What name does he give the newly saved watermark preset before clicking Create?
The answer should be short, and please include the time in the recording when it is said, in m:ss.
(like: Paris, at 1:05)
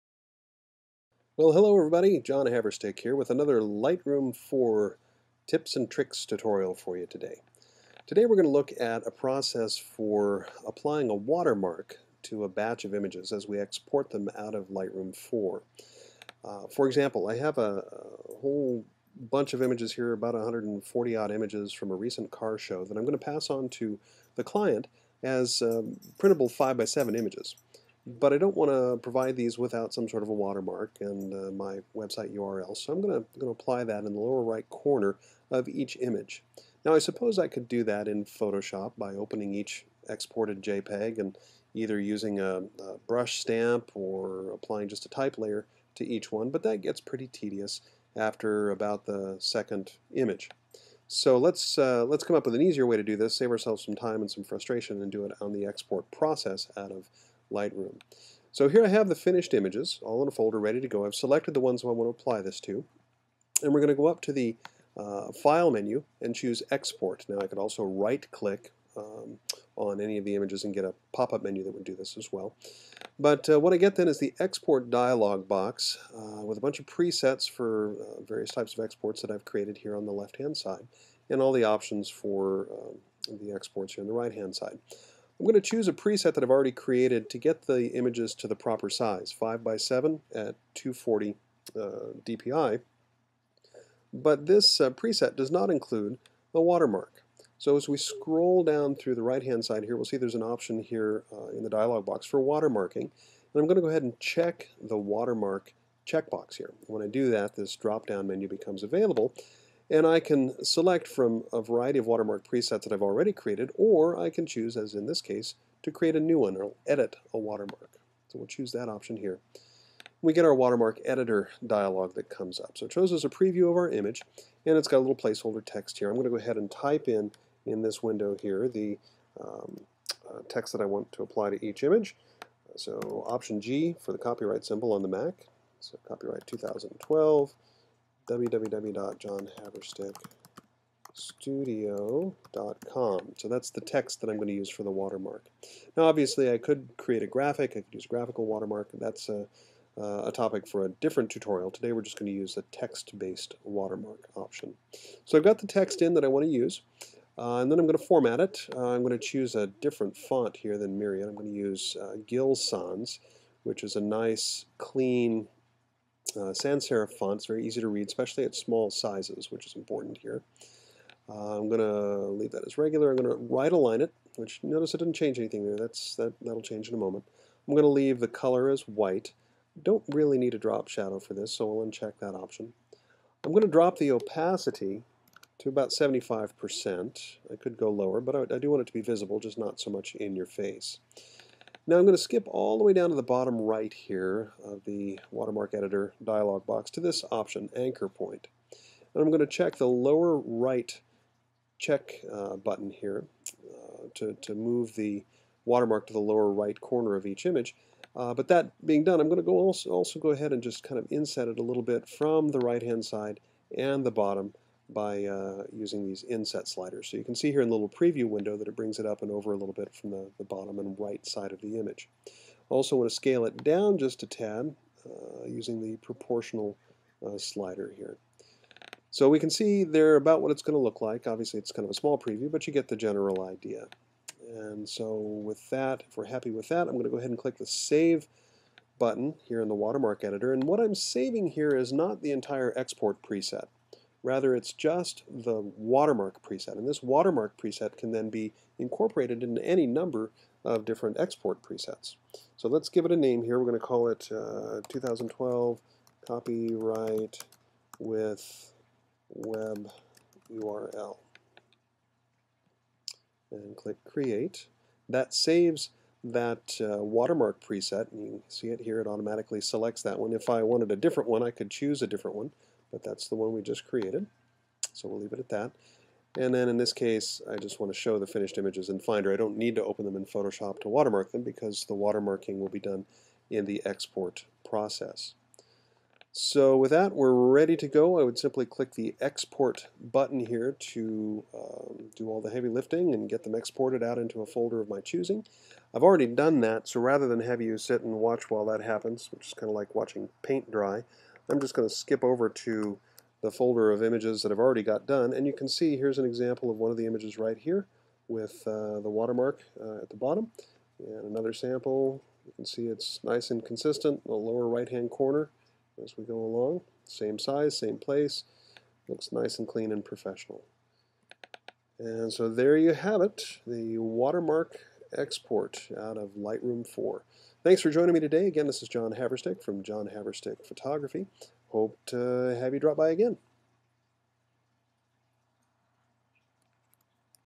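2012 copyright with web URL, at 4:14.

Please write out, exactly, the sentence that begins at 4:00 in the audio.
And what I'm saving here is not the entire export preset.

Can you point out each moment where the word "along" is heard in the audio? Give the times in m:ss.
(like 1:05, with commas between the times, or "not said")
5:16.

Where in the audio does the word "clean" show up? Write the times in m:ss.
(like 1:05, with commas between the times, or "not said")
2:44, 5:19.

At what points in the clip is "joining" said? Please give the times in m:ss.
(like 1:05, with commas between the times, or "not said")
5:27.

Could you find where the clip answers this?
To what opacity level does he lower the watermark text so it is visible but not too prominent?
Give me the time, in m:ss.
3:05.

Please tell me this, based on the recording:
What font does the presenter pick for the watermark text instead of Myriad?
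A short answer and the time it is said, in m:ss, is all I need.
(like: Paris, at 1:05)
Gill Sans, at 2:42.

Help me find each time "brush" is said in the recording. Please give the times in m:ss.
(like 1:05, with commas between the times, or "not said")
0:43.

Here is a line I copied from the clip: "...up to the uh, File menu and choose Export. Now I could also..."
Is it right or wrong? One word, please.
right.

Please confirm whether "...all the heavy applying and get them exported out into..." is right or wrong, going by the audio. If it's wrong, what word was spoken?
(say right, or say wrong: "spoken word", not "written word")
wrong: "lifting", not "applying".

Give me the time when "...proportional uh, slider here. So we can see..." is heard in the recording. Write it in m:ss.
3:45.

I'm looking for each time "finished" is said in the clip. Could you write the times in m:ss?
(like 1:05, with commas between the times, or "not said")
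0:59, 4:38.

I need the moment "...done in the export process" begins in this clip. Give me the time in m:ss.
4:42.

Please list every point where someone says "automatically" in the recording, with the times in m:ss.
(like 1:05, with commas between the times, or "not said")
4:29.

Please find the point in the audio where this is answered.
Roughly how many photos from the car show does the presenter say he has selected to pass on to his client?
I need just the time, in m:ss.
0:20.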